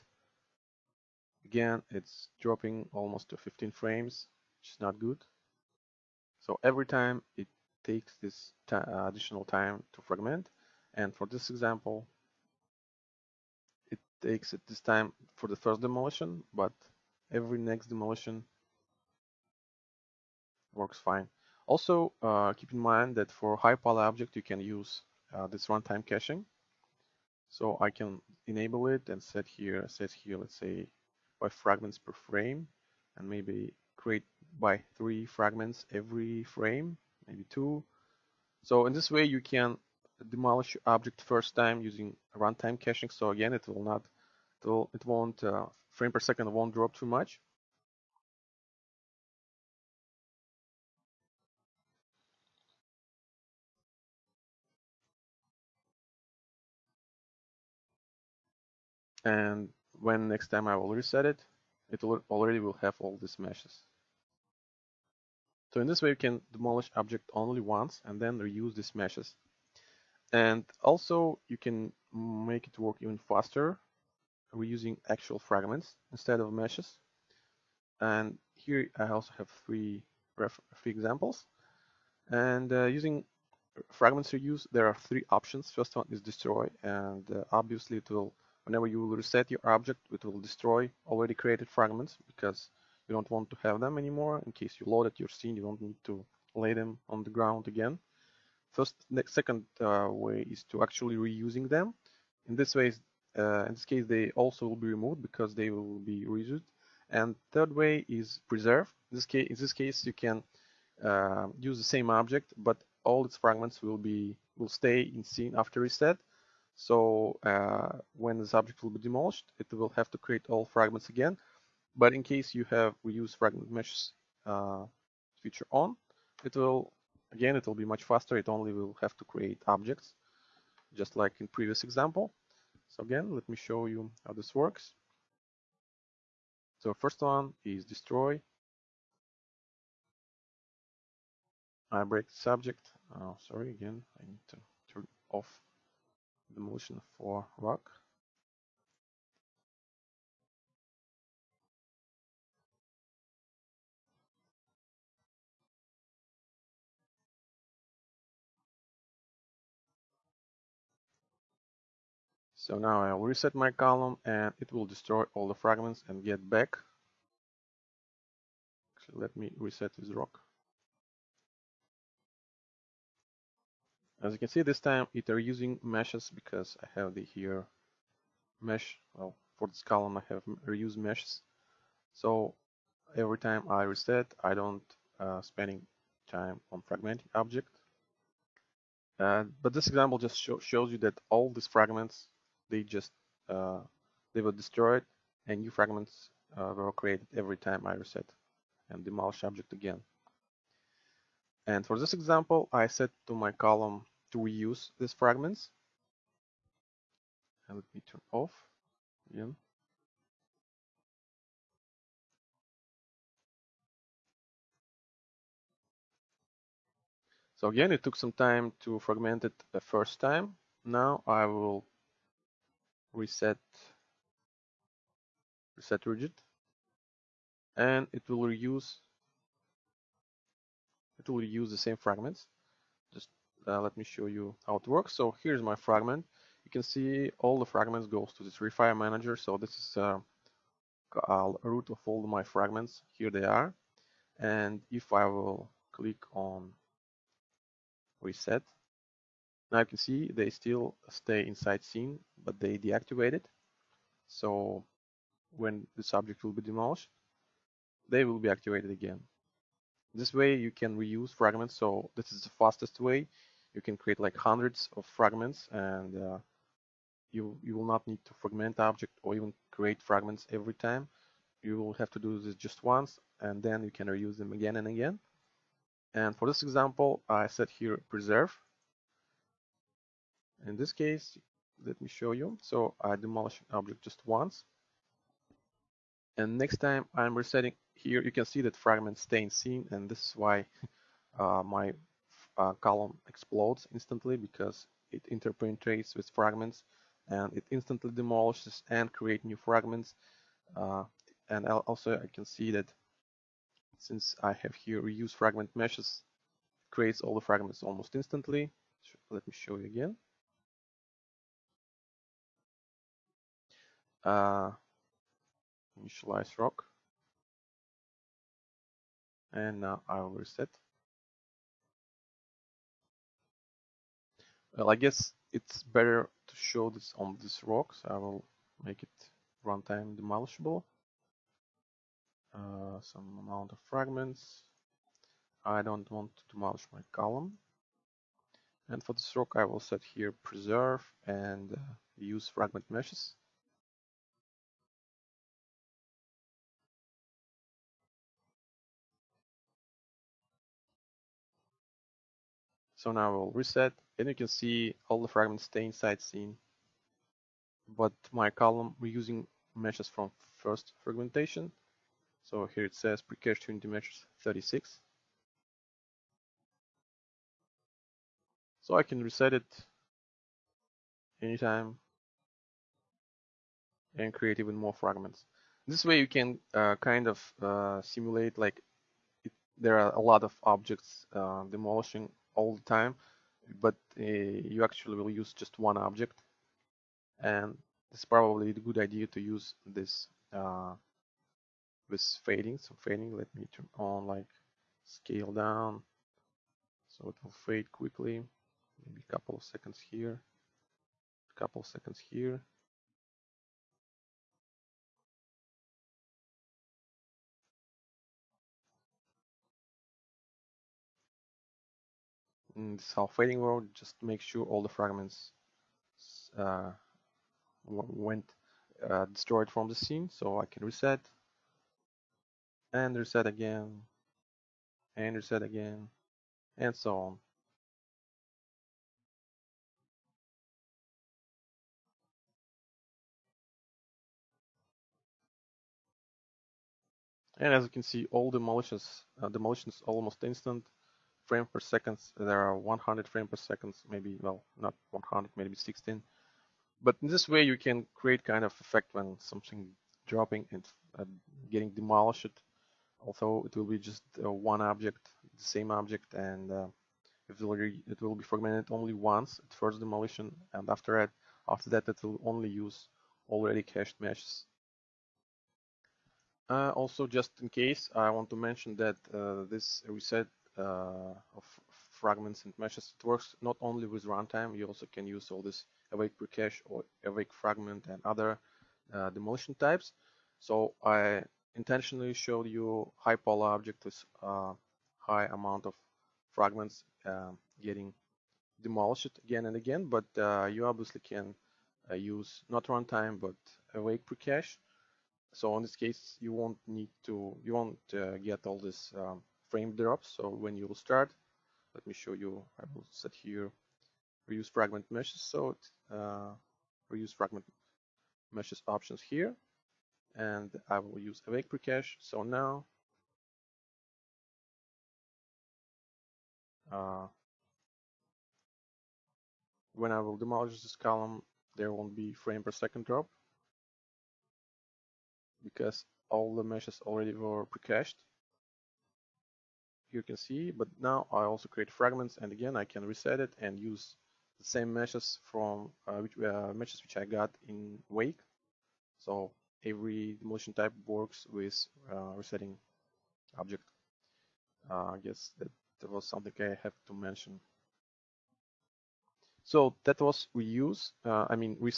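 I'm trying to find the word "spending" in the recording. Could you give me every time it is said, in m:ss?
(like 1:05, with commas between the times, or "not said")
3:05.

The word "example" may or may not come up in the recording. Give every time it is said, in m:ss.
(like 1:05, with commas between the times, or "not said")
0:11, 1:20, 2:11, 3:09, 3:22, 4:36.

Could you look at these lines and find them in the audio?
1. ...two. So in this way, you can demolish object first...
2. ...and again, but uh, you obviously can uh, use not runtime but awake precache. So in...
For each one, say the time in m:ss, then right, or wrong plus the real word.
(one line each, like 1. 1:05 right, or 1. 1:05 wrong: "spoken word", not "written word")
1. 0:37 right
2. 8:09 right.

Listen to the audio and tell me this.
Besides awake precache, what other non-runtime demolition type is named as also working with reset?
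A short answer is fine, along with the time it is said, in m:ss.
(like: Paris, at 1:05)
Awake fragment, at 7:57.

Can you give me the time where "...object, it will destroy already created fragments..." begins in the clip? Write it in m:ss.
1:29.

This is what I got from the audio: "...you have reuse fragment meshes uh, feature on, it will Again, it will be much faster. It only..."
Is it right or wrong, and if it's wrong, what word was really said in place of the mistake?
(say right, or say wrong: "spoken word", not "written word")
right.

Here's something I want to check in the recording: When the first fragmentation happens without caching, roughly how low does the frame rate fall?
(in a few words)
15 frames.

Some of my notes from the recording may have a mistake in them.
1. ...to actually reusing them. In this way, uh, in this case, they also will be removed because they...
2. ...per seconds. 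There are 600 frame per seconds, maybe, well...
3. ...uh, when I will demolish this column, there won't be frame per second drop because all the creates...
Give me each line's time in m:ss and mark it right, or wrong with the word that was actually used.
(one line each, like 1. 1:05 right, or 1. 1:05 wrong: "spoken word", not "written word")
1. 1:40 right
2. 7:21 wrong: "100", not "600"
3. 8:36 wrong: "meshes", not "creates".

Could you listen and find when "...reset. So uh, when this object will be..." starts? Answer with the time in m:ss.
1:55.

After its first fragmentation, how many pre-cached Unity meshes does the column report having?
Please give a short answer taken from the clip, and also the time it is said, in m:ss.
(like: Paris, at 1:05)
36, at 6:04.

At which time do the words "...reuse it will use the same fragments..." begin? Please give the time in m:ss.
3:48.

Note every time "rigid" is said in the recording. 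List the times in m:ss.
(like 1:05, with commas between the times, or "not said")
3:46.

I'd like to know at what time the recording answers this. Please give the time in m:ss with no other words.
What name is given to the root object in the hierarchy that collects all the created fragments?
3:58.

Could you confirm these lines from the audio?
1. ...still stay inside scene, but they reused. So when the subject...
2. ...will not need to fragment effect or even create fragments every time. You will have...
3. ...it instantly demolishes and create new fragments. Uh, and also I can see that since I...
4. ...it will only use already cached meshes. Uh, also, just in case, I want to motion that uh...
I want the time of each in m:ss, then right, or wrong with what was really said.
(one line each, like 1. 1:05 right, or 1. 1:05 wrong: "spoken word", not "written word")
1. 4:10 wrong: "deactivated", not "reused"
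2. 4:27 wrong: "object", not "effect"
3. 4:57 right
4. 7:42 wrong: "mention", not "motion".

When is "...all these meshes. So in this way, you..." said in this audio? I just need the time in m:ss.
1:02.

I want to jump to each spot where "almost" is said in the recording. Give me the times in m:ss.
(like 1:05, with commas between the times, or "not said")
0:02, 5:07, 7:20.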